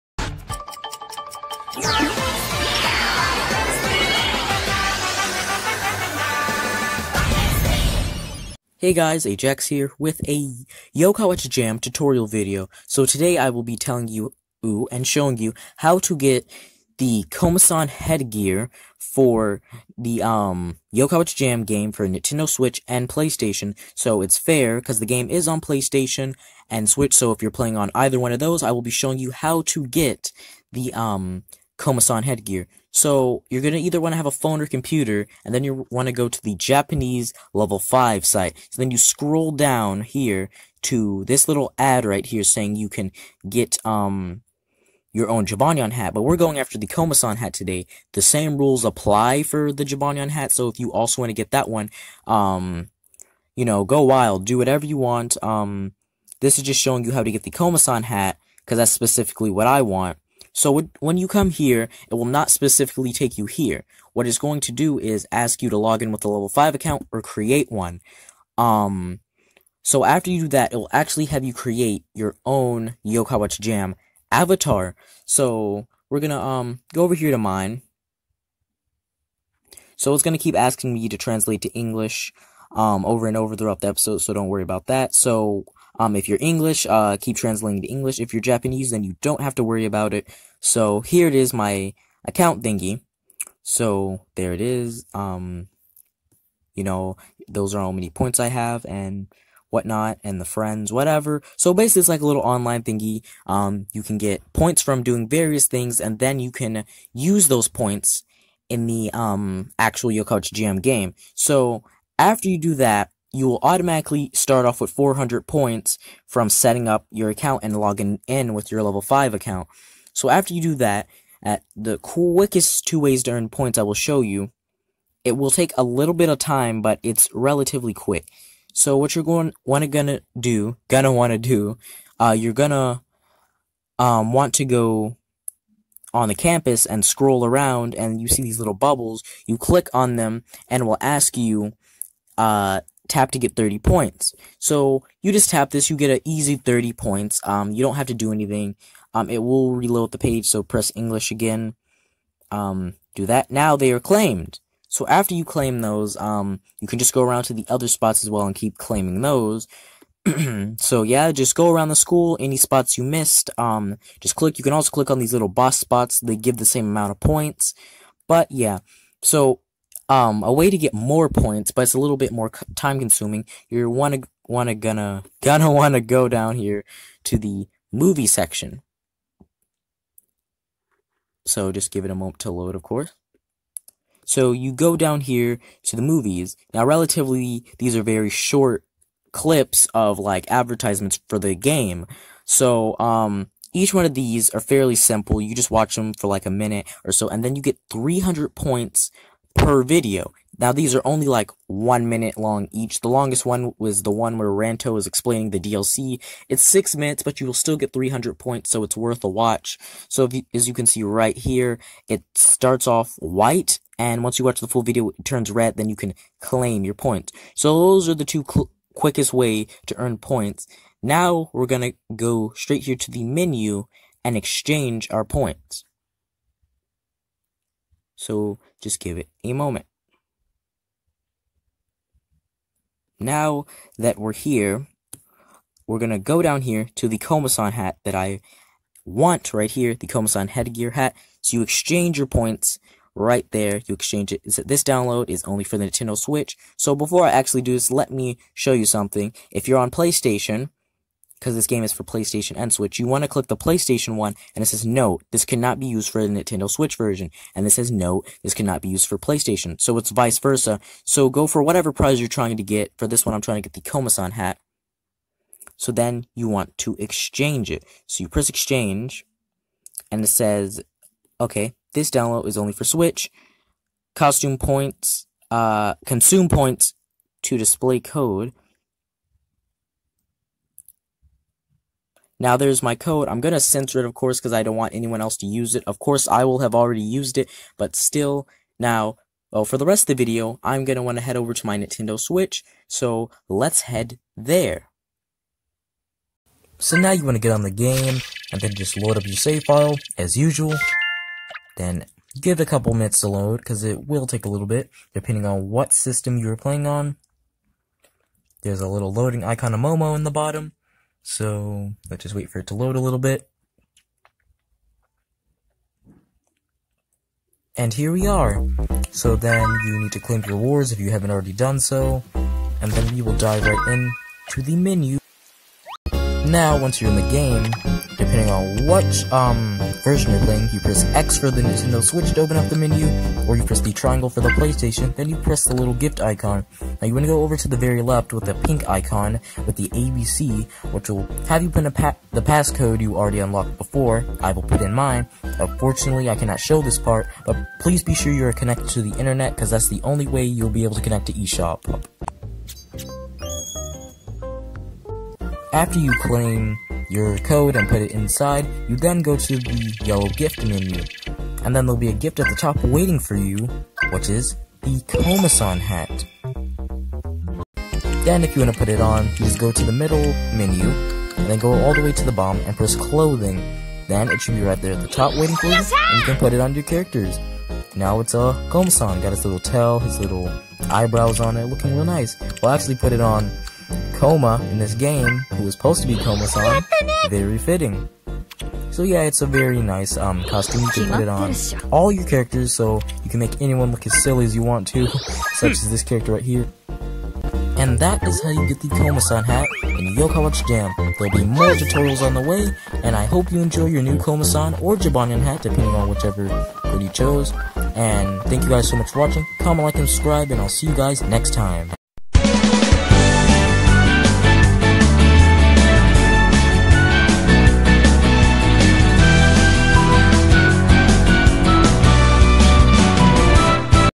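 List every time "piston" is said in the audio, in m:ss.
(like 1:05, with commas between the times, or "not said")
not said.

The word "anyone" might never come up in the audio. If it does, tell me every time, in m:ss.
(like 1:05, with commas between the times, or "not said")
4:44, 6:33.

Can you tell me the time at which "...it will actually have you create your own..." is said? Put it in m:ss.
1:10.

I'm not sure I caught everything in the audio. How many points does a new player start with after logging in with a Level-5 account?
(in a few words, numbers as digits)
400.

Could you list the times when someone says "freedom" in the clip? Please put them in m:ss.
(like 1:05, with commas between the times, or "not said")
not said.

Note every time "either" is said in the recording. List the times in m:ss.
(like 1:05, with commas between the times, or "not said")
0:27, 0:33.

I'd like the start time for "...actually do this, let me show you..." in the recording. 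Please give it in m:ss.
4:07.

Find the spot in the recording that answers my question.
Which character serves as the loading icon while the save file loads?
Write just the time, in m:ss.
5:09.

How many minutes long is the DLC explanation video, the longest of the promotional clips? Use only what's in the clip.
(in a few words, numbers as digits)
6.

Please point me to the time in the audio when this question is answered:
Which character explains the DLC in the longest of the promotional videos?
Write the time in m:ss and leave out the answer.
3:24.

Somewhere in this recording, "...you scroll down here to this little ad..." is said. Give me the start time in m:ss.
0:38.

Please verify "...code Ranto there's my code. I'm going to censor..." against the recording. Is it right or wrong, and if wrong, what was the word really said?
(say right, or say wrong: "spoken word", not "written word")
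wrong: "Now", not "Ranto".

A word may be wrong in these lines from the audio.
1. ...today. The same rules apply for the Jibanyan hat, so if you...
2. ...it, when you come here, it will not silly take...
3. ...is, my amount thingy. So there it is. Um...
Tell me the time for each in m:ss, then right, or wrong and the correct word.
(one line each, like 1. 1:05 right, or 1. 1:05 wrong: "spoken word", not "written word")
1. 0:47 right
2. 1:00 wrong: "specifically", not "silly"
3. 1:31 wrong: "account", not "amount".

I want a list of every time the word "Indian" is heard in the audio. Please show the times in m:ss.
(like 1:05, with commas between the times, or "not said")
not said.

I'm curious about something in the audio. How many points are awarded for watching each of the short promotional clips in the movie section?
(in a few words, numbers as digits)
300.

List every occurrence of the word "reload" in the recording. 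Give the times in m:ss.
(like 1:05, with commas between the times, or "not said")
2:29.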